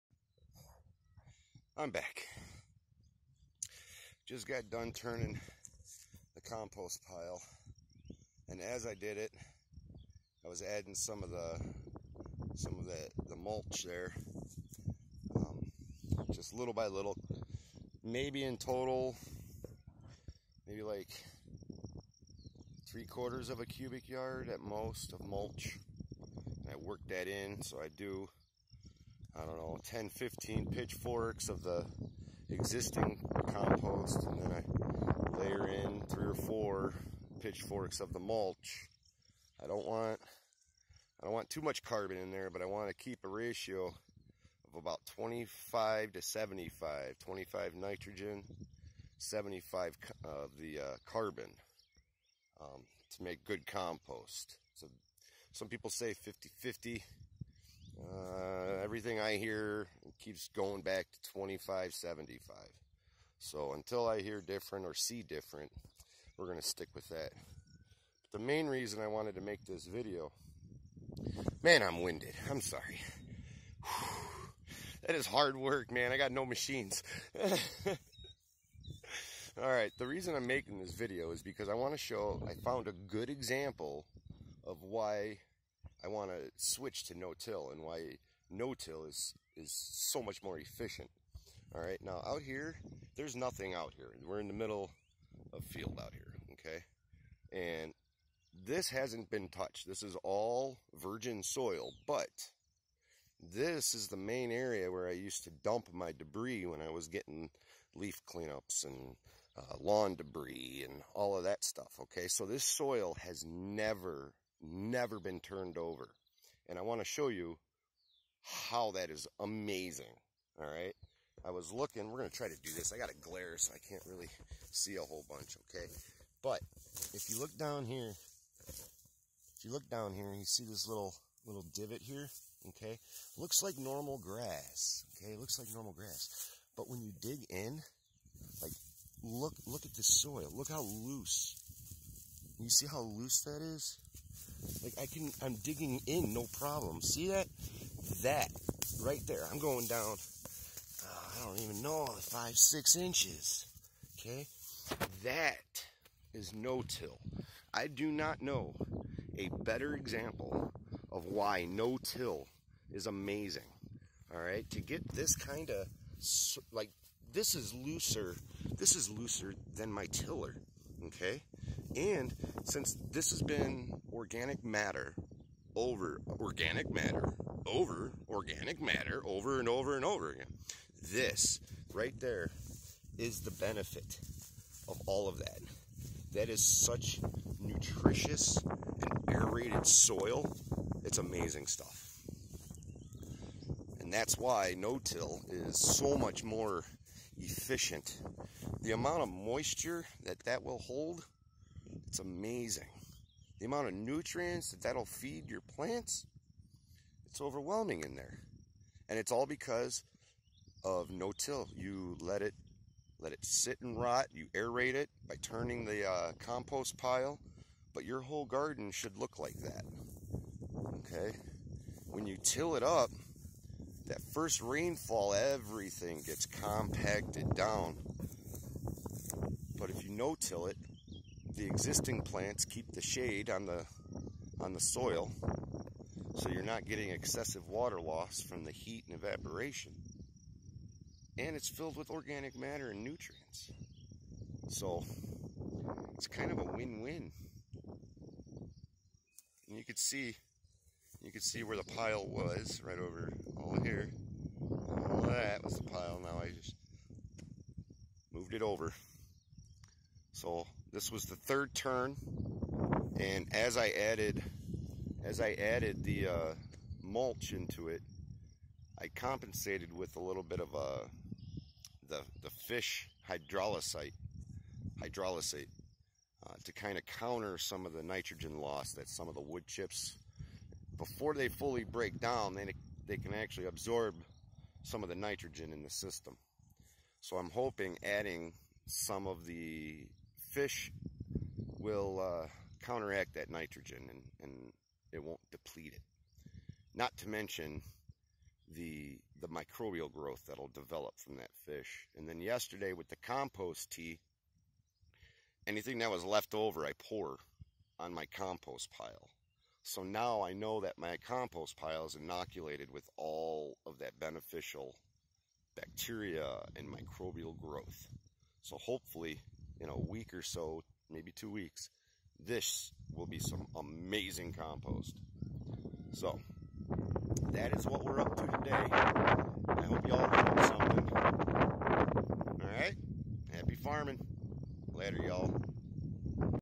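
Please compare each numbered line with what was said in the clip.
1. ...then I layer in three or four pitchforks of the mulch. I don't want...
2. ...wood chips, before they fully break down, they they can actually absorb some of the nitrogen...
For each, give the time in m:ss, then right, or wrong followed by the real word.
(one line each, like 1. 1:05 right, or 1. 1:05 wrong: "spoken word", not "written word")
1. 0:34 right
2. 4:39 right.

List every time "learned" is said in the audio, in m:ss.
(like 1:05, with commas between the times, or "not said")
5:30.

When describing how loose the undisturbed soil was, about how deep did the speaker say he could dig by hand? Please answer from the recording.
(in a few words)
5-6 inches.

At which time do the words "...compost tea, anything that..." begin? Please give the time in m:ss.
5:03.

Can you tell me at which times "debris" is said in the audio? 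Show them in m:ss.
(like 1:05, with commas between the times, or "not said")
1:46, 1:50.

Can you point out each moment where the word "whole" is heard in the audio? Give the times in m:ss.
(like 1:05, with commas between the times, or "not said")
2:05, 3:38.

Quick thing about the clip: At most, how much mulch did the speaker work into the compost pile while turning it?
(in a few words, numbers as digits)
3/4 cubic yard.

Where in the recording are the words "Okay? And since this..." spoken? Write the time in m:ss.
2:51.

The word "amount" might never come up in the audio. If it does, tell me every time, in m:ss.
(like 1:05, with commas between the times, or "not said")
3:18, 3:23.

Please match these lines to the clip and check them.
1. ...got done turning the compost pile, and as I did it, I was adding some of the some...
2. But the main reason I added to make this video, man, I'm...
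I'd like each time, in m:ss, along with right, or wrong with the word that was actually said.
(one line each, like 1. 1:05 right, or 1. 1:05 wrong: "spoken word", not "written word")
1. 0:04 right
2. 1:08 wrong: "wanted", not "added".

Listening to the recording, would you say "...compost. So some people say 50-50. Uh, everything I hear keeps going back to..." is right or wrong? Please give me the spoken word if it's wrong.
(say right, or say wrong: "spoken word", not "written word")
right.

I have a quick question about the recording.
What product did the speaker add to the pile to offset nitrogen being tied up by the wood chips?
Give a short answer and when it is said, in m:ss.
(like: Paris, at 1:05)
fish hydrolysate, at 4:32.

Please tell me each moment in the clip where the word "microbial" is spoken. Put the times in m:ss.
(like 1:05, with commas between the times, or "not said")
4:59, 5:16.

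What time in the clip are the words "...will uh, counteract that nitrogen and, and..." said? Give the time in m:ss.
4:51.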